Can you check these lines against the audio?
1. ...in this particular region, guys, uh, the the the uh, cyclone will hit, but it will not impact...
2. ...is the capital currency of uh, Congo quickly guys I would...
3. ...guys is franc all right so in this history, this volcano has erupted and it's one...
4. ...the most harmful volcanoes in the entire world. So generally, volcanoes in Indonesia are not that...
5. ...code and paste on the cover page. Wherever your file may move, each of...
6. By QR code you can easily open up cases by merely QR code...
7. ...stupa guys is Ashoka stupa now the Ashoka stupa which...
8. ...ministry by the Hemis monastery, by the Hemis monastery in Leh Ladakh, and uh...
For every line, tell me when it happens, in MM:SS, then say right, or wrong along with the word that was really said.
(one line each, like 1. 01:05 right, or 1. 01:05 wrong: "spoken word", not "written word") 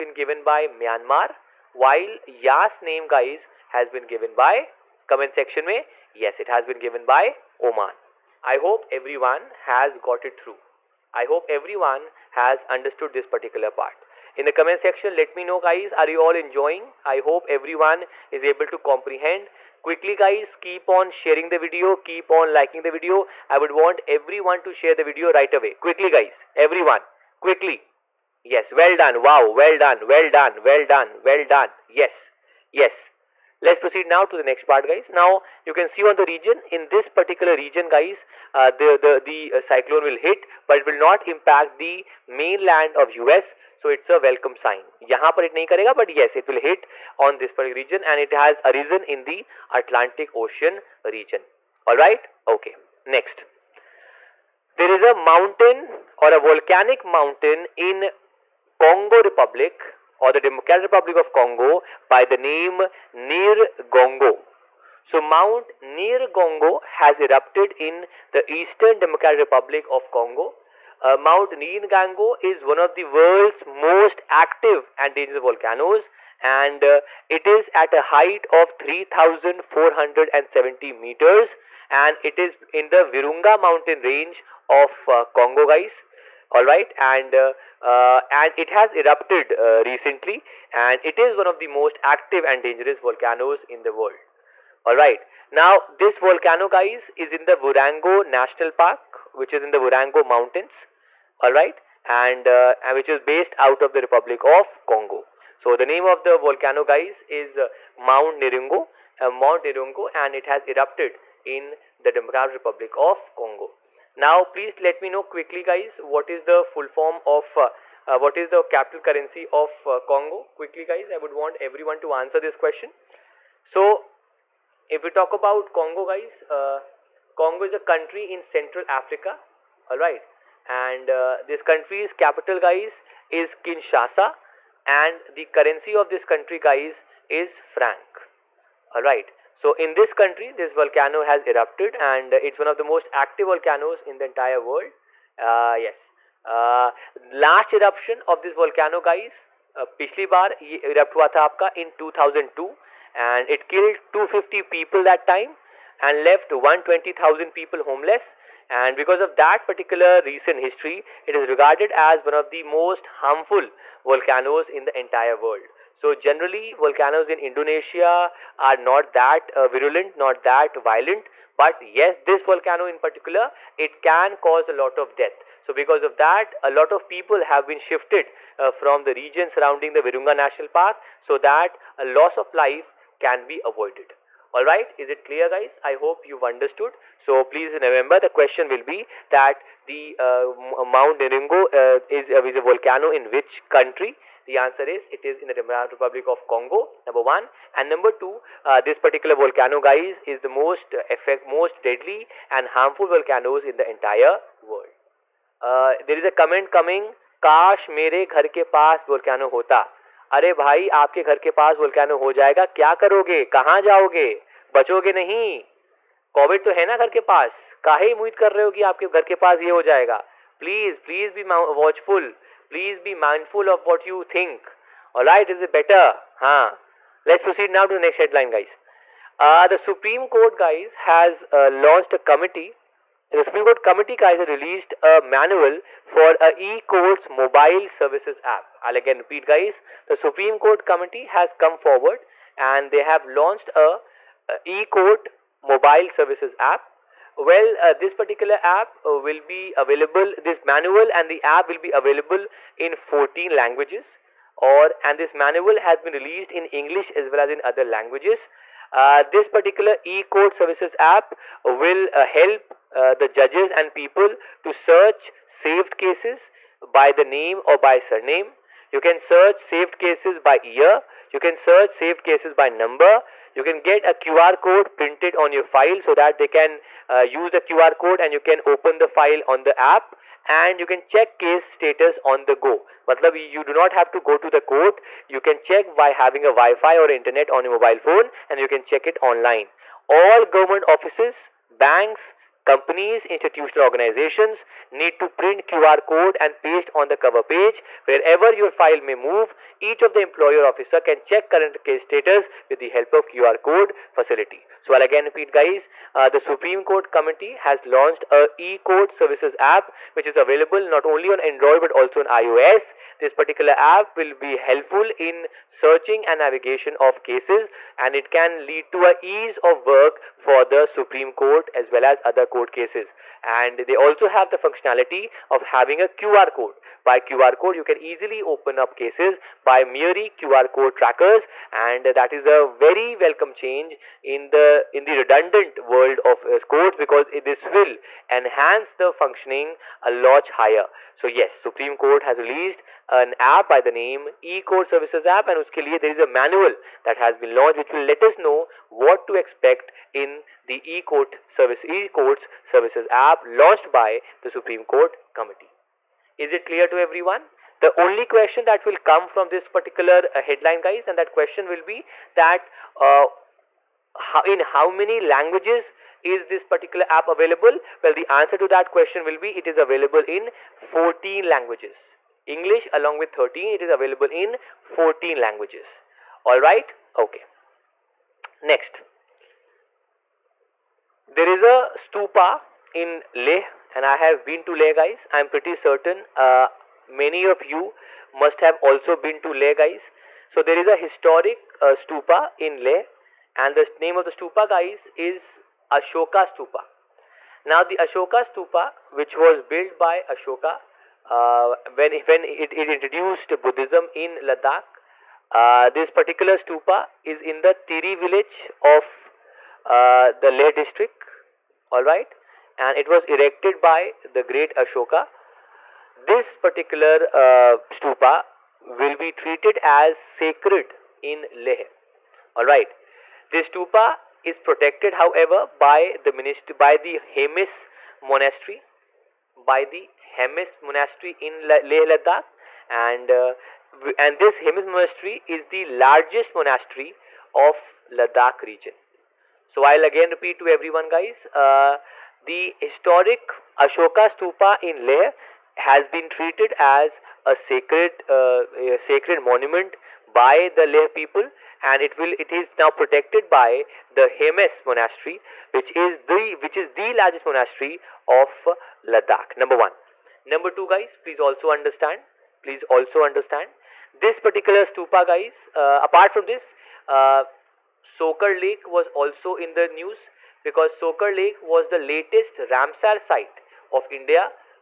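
1. 00:36 right
2. 01:58 right
3. 02:16 wrong: "country", not "history"
4. 02:42 right
5. 04:56 right
6. 05:27 right
7. 06:34 right
8. 07:06 right.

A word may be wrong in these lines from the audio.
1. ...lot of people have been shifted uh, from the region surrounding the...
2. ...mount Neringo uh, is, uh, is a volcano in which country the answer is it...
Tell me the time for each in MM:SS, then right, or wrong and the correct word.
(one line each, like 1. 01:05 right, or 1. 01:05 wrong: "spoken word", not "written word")
1. 02:56 right
2. 03:10 right.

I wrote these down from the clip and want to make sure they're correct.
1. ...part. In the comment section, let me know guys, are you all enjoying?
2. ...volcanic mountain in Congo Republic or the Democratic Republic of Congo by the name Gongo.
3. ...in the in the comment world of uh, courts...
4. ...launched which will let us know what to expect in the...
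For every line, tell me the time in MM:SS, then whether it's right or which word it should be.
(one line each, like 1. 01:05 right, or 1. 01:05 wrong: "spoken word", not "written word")
1. 00:13 right
2. 00:56 right
3. 05:34 wrong: "redundant", not "comment"
4. 05:47 right.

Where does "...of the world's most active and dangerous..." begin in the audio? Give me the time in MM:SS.
01:12.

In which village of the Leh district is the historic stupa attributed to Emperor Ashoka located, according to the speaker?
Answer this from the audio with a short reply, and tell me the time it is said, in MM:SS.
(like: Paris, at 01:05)
Tiri, at 06:47.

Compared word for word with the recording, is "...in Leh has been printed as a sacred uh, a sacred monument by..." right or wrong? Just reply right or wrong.
wrong.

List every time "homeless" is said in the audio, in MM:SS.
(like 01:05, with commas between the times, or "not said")
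02:37.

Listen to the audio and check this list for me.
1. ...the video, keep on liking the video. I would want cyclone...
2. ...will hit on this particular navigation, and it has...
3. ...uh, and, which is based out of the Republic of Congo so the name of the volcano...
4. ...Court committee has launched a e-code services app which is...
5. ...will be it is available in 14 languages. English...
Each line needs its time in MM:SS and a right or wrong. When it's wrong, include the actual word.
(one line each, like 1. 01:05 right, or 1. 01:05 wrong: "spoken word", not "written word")
1. 00:21 wrong: "everyone", not "cyclone"
2. 00:46 wrong: "region", not "navigation"
3. 01:41 right
4. 05:06 right
5. 06:09 right.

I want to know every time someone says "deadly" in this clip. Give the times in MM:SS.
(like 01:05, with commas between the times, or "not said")
03:21.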